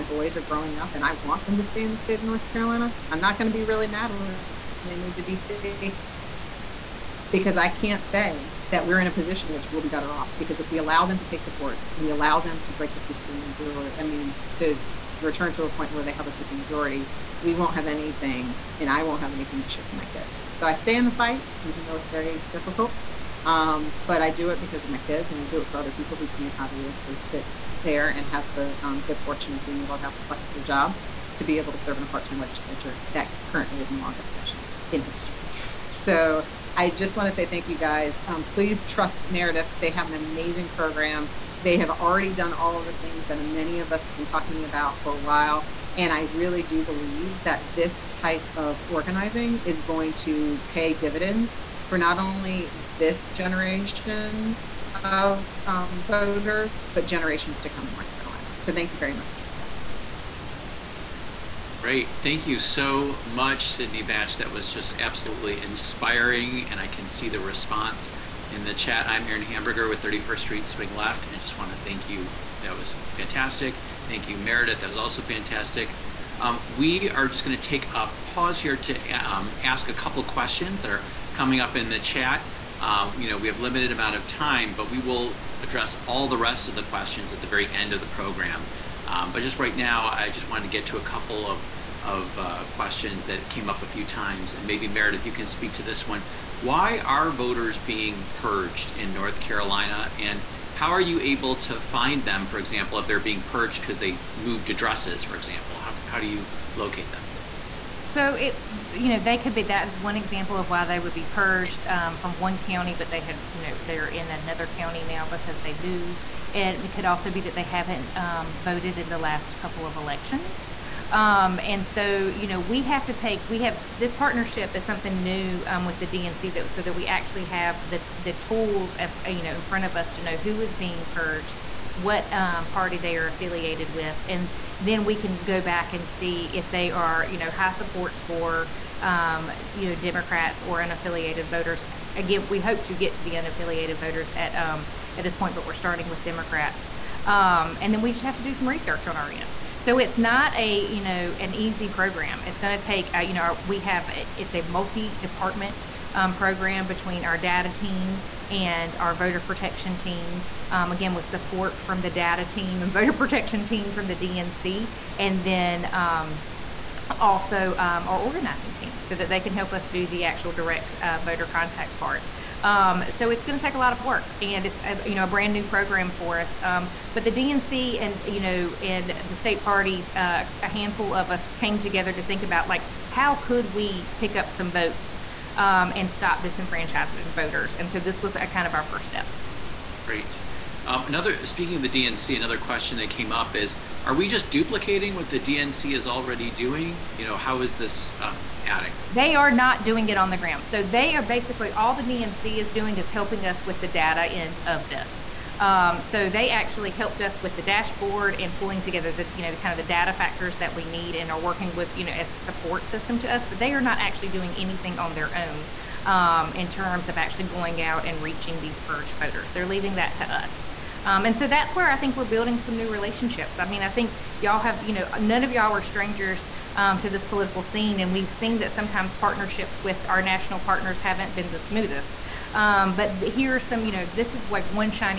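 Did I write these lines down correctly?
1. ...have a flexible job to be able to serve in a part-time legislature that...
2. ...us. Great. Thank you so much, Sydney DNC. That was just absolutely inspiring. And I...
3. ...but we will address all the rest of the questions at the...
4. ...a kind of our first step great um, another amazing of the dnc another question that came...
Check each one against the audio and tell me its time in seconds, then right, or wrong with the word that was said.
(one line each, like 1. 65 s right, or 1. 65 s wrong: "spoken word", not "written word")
1. 30 s right
2. 59 s wrong: "Batch", not "DNC"
3. 84 s right
4. 188 s wrong: "speaking", not "amazing".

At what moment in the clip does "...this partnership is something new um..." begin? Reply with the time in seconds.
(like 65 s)
123 s.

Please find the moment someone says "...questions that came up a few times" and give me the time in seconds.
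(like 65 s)
92 s.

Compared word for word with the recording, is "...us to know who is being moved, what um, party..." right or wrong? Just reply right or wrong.
wrong.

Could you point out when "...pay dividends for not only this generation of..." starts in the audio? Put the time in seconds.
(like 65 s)
50 s.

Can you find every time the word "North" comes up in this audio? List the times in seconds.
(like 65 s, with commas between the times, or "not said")
2 s, 57 s, 99 s.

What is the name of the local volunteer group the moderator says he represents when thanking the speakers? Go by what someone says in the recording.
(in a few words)
31st Street Swing Left.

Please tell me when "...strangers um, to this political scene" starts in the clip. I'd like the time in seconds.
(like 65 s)
225 s.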